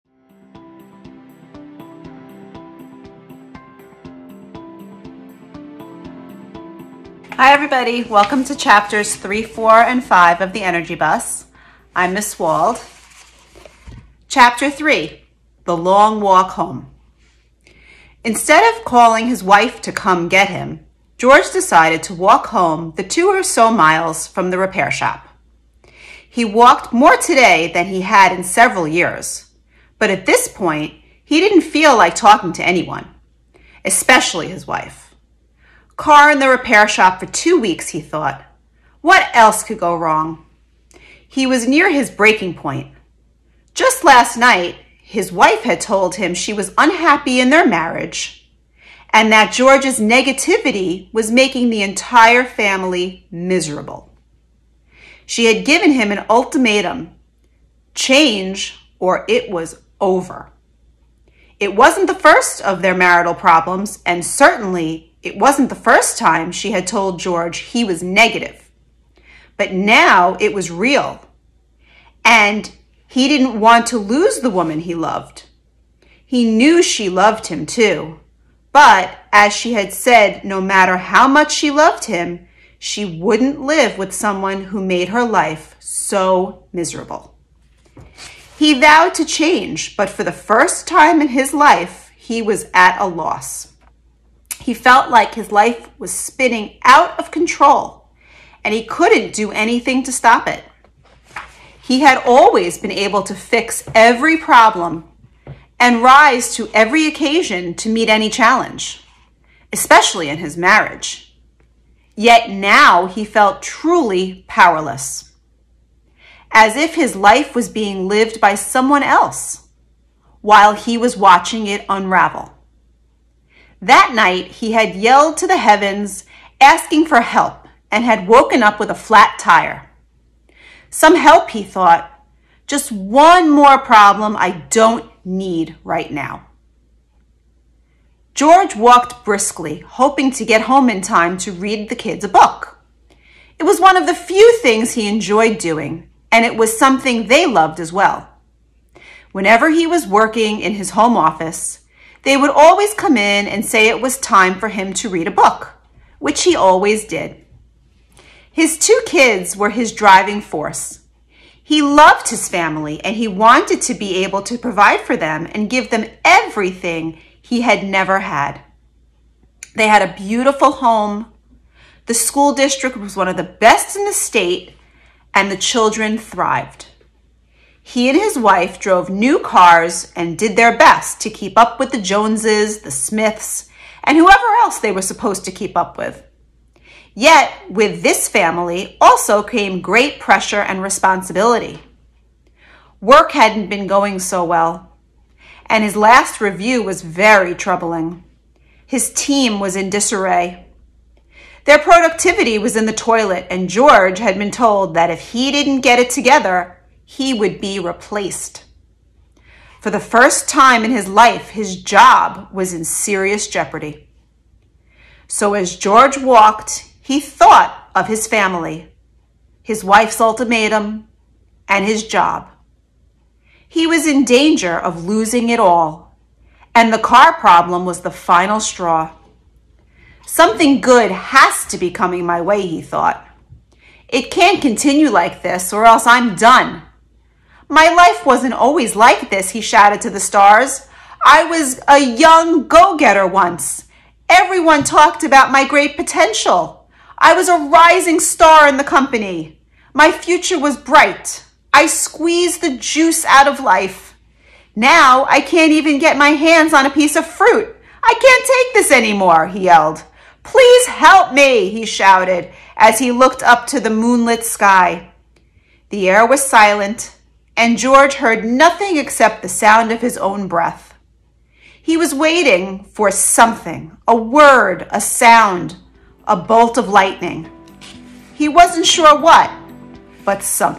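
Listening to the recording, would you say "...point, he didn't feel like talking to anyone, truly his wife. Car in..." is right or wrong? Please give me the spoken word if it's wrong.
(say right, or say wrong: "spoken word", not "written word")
wrong: "especially", not "truly".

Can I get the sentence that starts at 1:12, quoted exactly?
And he didn't want to lose the woman he loved.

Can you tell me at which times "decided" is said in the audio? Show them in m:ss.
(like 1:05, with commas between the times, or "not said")
0:21.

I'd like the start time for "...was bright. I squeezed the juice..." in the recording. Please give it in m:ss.
4:10.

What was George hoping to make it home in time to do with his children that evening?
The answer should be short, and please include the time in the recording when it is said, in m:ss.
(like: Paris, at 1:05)
Read the kids a book, at 2:21.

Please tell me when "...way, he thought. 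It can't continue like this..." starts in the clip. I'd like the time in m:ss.
3:52.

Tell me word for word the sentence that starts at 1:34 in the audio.
He felt like his life was spinning out of control and he couldn't do anything to stop it.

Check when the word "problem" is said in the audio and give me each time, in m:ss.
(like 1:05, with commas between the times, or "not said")
1:03, 1:44, 2:13, 3:47.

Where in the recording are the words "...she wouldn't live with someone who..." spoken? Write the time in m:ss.
1:22.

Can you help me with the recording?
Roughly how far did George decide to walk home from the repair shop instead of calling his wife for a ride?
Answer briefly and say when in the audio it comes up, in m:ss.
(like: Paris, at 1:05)
2 miles, at 0:23.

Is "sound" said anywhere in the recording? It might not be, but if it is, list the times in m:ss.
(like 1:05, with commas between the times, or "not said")
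4:29, 4:34.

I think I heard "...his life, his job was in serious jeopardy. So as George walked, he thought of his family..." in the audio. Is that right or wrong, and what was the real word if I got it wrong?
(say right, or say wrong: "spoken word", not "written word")
right.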